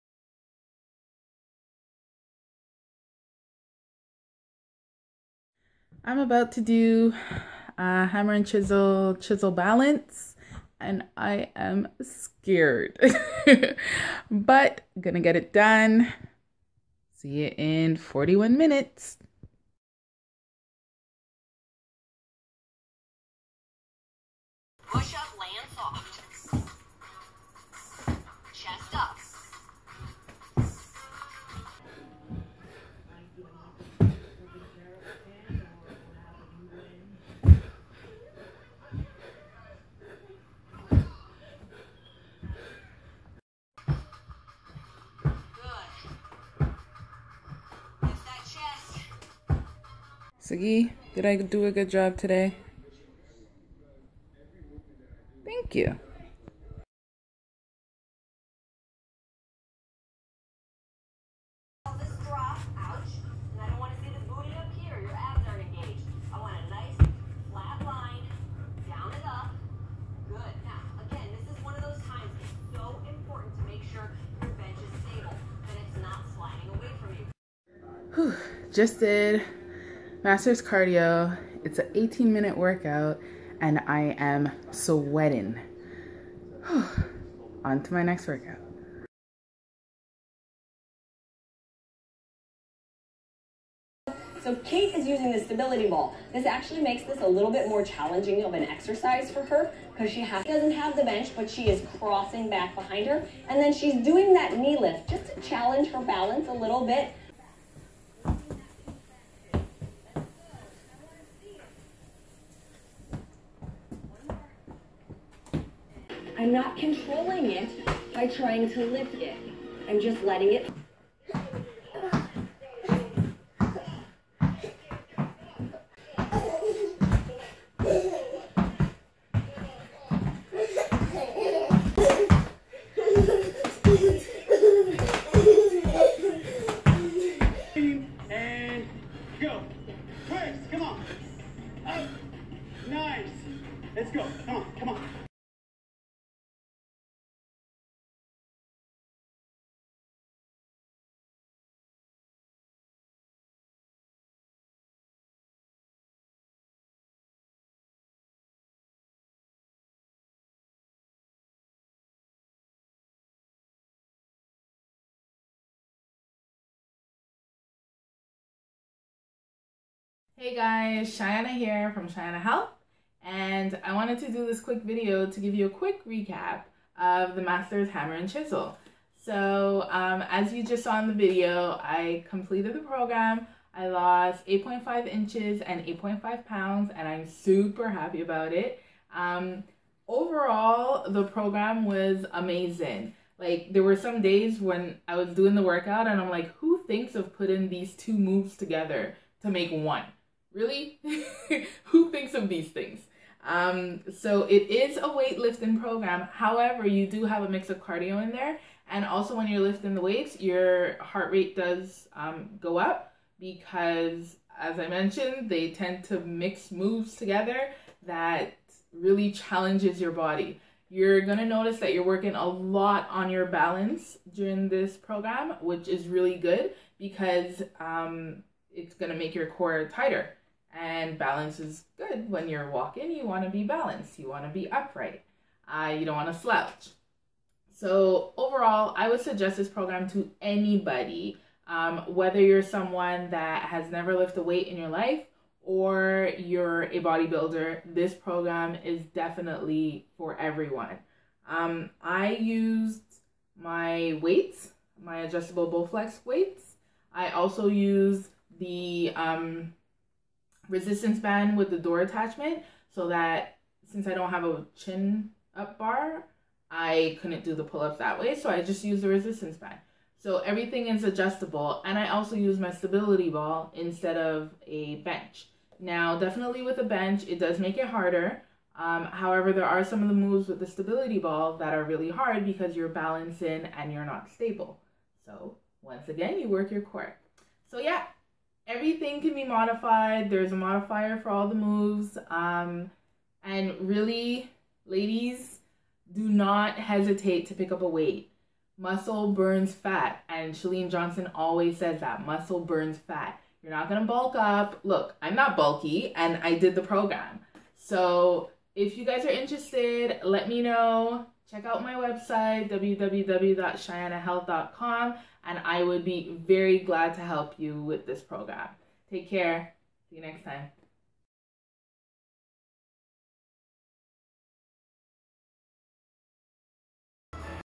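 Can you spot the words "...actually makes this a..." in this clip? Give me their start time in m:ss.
1:36.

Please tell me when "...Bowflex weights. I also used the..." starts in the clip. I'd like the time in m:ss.
4:15.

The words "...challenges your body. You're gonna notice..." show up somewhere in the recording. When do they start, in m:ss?
3:39.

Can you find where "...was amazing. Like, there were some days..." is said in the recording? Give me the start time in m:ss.
3:11.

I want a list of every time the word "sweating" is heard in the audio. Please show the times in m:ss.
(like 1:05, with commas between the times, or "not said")
1:24.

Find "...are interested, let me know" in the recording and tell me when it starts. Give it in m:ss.
5:09.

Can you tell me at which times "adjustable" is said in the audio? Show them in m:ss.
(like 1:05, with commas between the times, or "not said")
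4:15, 4:31.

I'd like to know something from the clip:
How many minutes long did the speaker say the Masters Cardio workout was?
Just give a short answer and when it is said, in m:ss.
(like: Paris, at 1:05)
18, at 1:21.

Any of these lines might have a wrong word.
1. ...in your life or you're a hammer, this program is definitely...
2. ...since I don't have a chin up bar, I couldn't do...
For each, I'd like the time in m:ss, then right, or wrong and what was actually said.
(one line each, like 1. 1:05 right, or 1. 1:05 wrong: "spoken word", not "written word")
1. 4:04 wrong: "bodybuilder", not "hammer"
2. 4:23 right.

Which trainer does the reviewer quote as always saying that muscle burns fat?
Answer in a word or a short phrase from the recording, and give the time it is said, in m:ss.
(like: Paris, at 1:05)
Chalene Johnson, at 5:00.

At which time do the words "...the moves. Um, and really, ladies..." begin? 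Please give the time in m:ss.
4:51.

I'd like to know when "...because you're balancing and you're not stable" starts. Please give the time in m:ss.
4:42.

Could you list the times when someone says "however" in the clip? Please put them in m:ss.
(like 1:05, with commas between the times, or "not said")
3:26, 4:39.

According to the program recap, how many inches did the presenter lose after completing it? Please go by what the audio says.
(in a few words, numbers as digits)
8.5 inches.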